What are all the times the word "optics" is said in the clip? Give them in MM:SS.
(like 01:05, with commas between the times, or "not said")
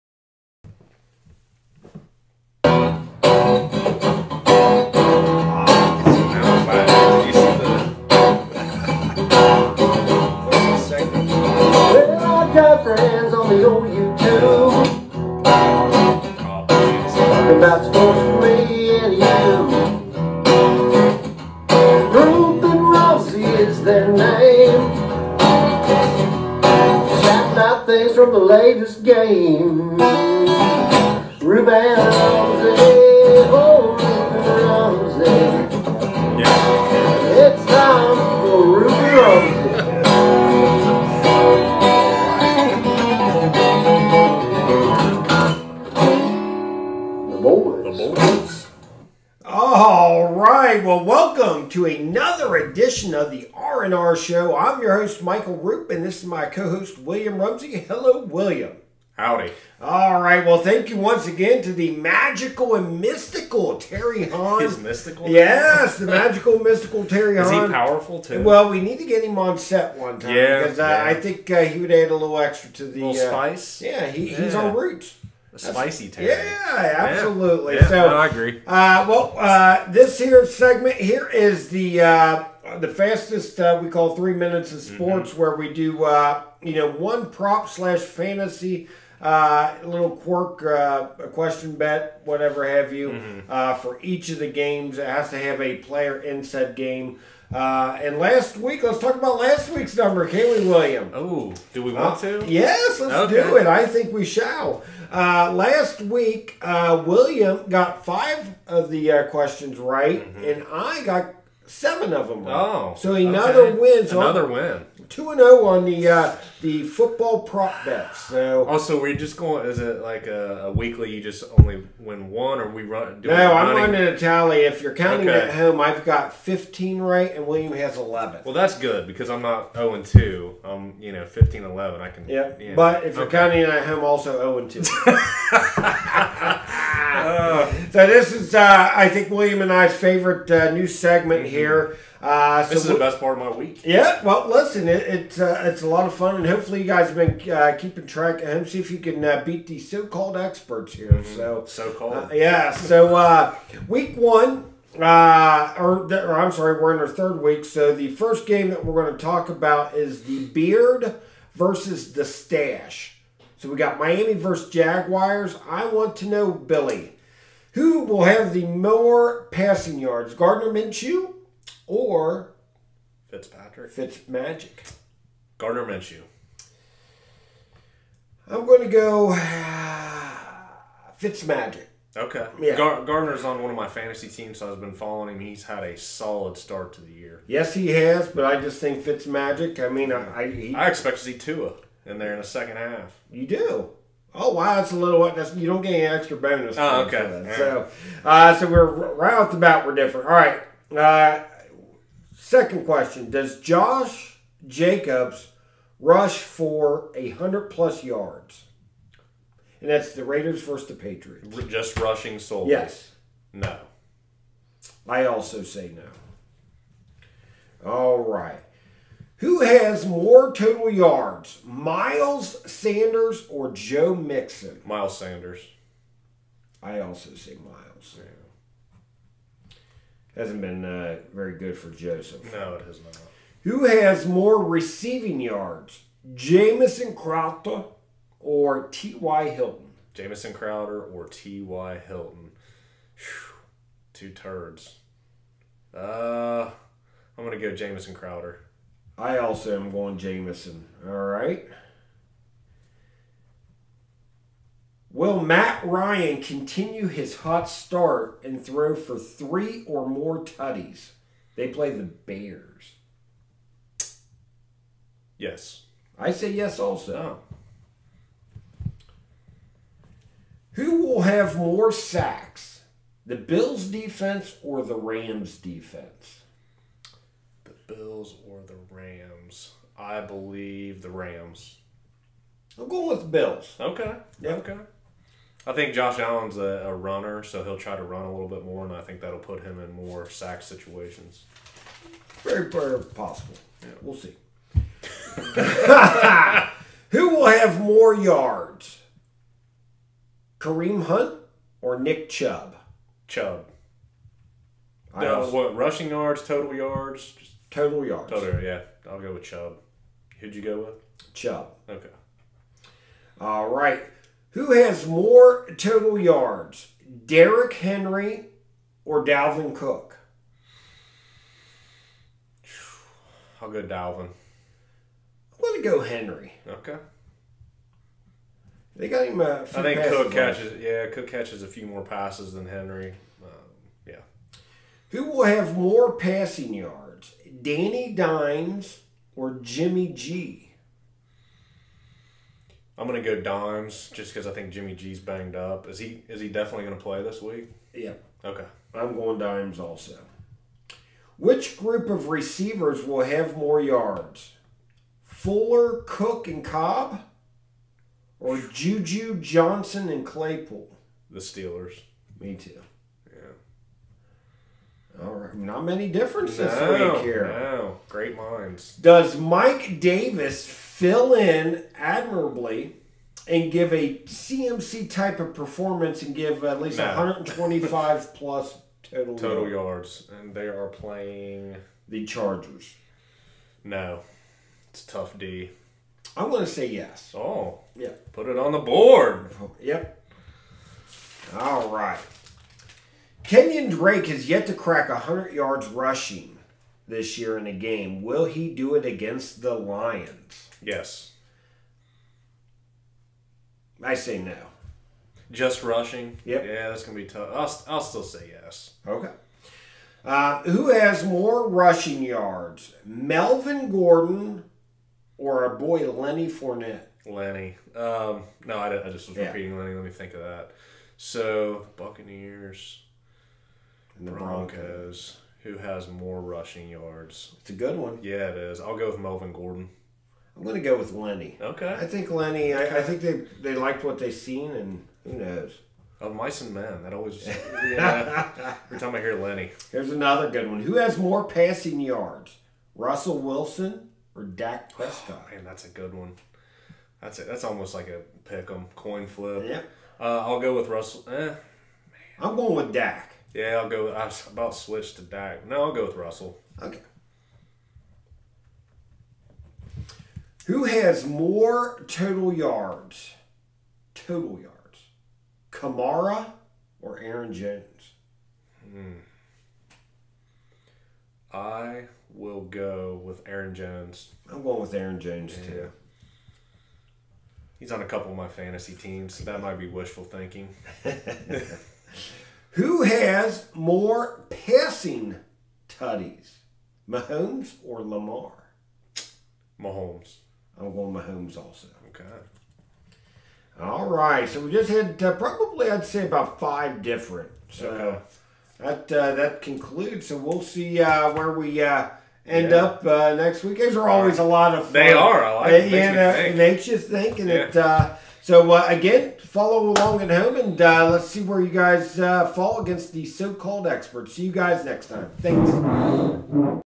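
not said.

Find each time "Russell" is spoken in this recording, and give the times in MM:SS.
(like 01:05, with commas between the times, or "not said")
07:22, 07:30, 07:36.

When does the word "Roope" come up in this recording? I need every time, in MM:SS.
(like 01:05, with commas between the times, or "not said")
00:55.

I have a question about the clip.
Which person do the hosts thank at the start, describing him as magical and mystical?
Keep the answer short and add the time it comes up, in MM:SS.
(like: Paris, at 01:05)
Terry Hahn, at 01:03.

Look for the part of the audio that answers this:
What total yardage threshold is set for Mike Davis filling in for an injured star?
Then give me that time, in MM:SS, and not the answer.
06:17.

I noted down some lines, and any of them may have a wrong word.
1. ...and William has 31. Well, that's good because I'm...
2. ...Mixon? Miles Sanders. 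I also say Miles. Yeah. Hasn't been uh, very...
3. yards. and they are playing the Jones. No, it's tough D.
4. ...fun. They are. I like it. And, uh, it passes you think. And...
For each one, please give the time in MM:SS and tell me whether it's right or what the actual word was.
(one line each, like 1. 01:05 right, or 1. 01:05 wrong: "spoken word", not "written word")
1. 02:07 wrong: "11", not "31"
2. 03:44 right
3. 06:20 wrong: "Chargers", not "Jones"
4. 08:24 wrong: "makes", not "passes".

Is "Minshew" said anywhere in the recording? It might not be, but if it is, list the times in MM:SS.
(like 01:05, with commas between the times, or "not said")
02:50, 02:55.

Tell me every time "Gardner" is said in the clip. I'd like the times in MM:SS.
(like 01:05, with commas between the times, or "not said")
02:50, 02:55, 03:03.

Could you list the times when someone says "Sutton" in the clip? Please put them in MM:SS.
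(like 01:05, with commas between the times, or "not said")
not said.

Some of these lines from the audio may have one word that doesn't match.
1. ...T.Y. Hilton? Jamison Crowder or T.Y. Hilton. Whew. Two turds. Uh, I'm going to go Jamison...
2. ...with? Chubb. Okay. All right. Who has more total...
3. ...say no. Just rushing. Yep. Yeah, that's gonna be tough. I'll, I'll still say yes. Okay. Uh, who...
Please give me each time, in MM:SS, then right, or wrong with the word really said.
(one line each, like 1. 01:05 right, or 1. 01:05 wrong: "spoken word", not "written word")
1. 03:58 right
2. 05:10 right
3. 06:44 right.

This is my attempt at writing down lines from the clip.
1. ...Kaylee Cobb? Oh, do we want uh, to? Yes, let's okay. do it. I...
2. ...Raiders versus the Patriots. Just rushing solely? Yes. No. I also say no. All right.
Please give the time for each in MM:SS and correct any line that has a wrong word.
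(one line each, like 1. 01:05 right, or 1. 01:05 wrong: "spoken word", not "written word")
1. 01:40 wrong: "William", not "Cobb"
2. 03:30 right.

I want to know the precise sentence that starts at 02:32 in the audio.
So uh, week one, or, or I'm sorry, we're in our third week.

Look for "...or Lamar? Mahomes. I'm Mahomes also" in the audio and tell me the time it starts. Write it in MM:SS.
08:07.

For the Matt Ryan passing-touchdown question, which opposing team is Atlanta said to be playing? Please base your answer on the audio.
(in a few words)
Bears.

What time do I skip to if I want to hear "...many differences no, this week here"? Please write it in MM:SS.
06:05.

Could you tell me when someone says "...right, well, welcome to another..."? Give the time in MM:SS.
00:50.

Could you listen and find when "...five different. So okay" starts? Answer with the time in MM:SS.
08:16.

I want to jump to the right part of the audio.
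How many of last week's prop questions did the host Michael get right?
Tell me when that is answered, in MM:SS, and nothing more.
01:51.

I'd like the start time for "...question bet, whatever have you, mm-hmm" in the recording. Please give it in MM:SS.
01:31.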